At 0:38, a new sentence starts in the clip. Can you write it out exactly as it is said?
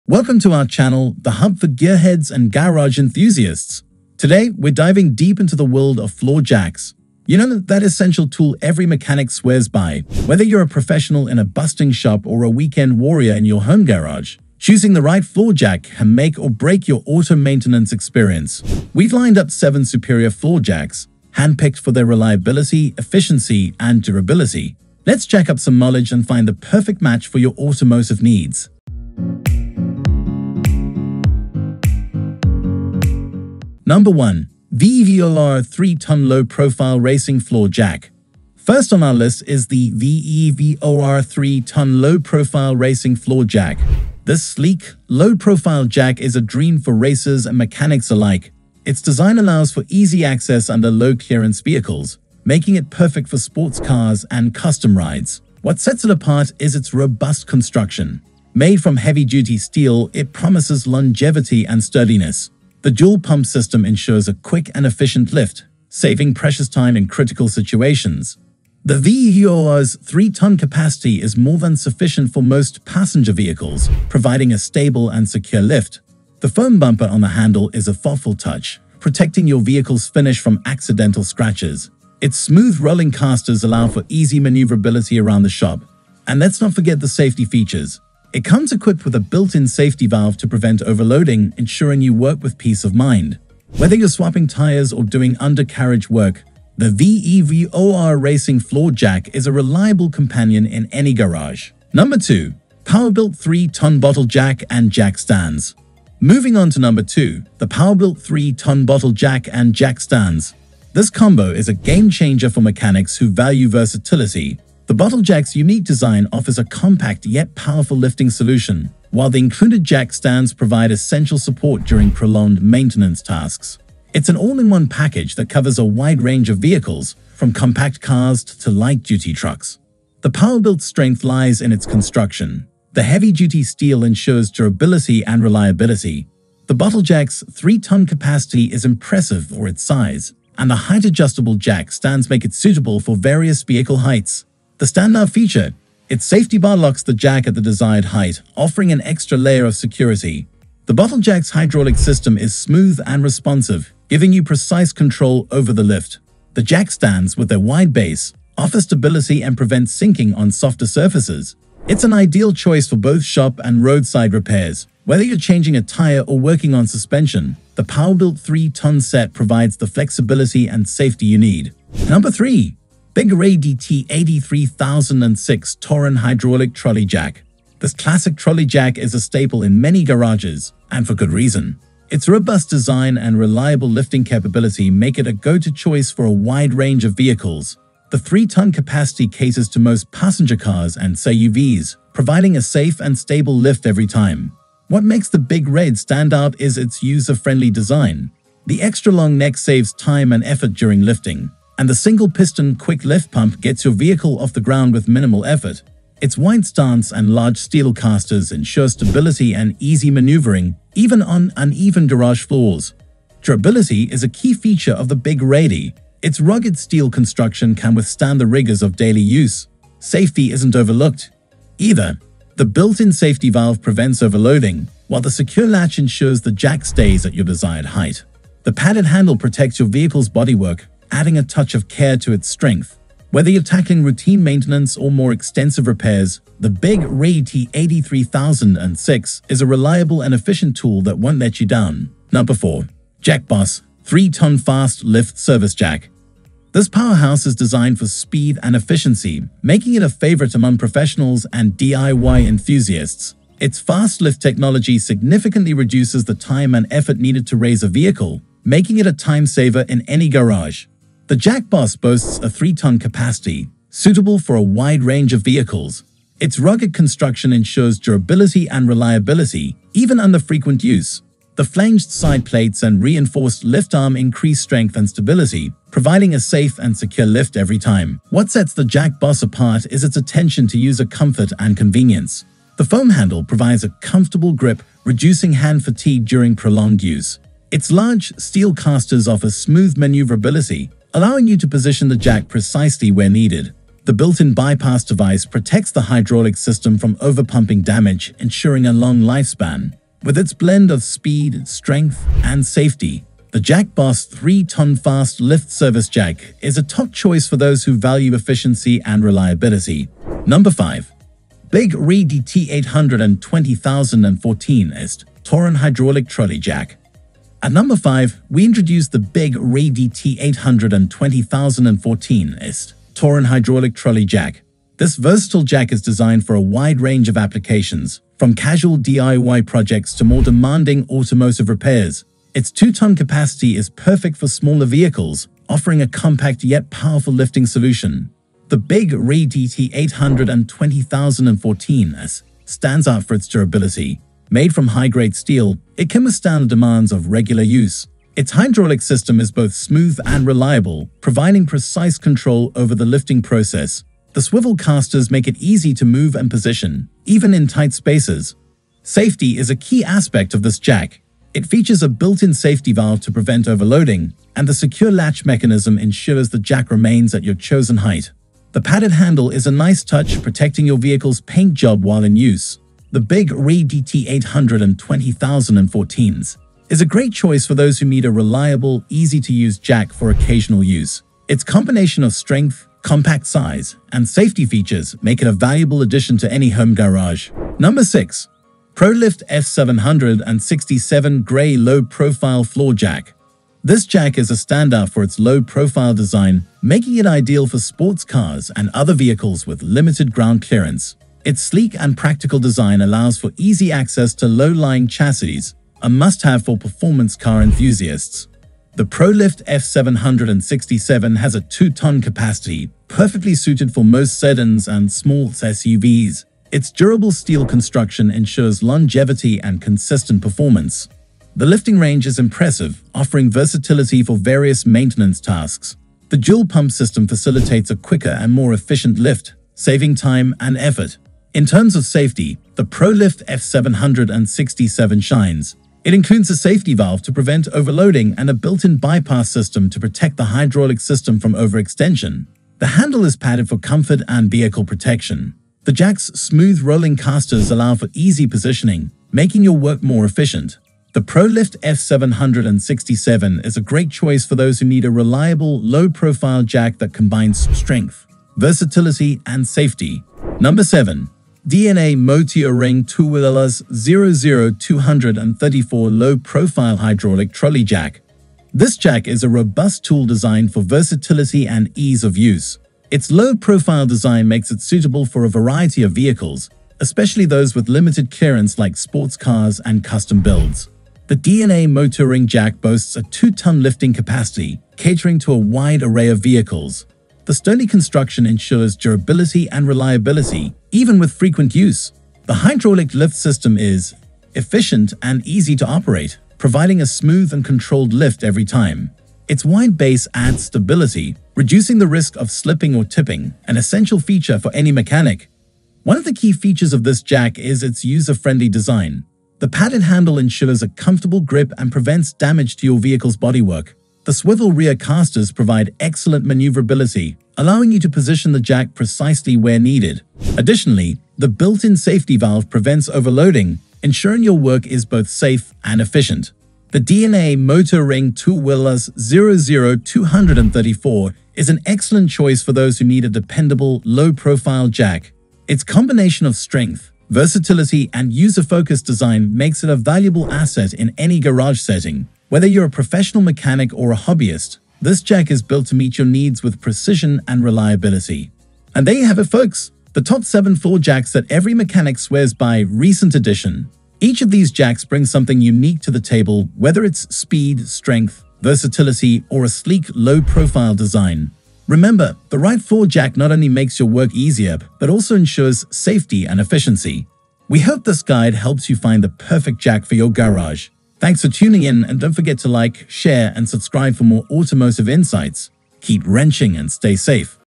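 First on our list is the VEVOR 3-ton low-profile racing floor jack.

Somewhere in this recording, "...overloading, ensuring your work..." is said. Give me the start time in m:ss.
8:43.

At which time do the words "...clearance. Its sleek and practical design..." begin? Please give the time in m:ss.
6:40.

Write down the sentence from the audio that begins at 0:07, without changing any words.
You know that essential tool every mechanic swears by.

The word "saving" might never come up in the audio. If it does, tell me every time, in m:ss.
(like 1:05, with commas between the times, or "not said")
1:05, 7:09.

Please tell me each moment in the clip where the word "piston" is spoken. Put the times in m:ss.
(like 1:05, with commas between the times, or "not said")
3:22.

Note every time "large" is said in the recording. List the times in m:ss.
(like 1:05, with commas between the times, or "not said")
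3:27, 4:47.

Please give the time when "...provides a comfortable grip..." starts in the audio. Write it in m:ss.
4:43.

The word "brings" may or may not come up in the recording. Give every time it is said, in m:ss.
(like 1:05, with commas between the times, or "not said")
9:15.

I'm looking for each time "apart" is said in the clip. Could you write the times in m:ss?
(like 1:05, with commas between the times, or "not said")
0:56, 4:39.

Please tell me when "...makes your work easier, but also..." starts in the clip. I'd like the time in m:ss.
9:23.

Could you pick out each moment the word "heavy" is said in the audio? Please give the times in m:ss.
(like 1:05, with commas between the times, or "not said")
0:58, 2:13.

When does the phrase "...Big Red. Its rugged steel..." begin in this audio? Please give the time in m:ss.
3:35.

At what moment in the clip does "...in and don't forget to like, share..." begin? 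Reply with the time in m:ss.
9:31.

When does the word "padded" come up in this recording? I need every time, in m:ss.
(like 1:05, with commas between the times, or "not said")
3:48, 6:08, 7:23, 8:29.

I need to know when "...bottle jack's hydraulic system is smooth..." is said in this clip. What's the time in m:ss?
2:30.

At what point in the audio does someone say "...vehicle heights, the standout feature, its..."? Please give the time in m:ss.
2:23.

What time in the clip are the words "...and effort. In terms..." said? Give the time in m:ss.
7:10.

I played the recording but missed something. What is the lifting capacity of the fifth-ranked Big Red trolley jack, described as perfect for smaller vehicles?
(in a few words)
2 tons.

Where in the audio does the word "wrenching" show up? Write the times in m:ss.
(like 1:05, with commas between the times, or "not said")
9:36.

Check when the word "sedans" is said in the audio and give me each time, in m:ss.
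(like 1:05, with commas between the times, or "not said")
6:54.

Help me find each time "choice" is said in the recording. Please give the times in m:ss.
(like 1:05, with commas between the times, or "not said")
2:42, 3:05, 5:07, 6:17, 7:34, 8:52.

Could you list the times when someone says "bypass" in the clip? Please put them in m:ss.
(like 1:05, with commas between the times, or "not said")
4:54, 7:18.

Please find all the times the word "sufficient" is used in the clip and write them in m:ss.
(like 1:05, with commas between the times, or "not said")
1:11.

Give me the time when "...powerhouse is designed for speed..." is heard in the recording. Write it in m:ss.
4:06.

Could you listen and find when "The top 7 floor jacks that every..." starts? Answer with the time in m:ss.
9:10.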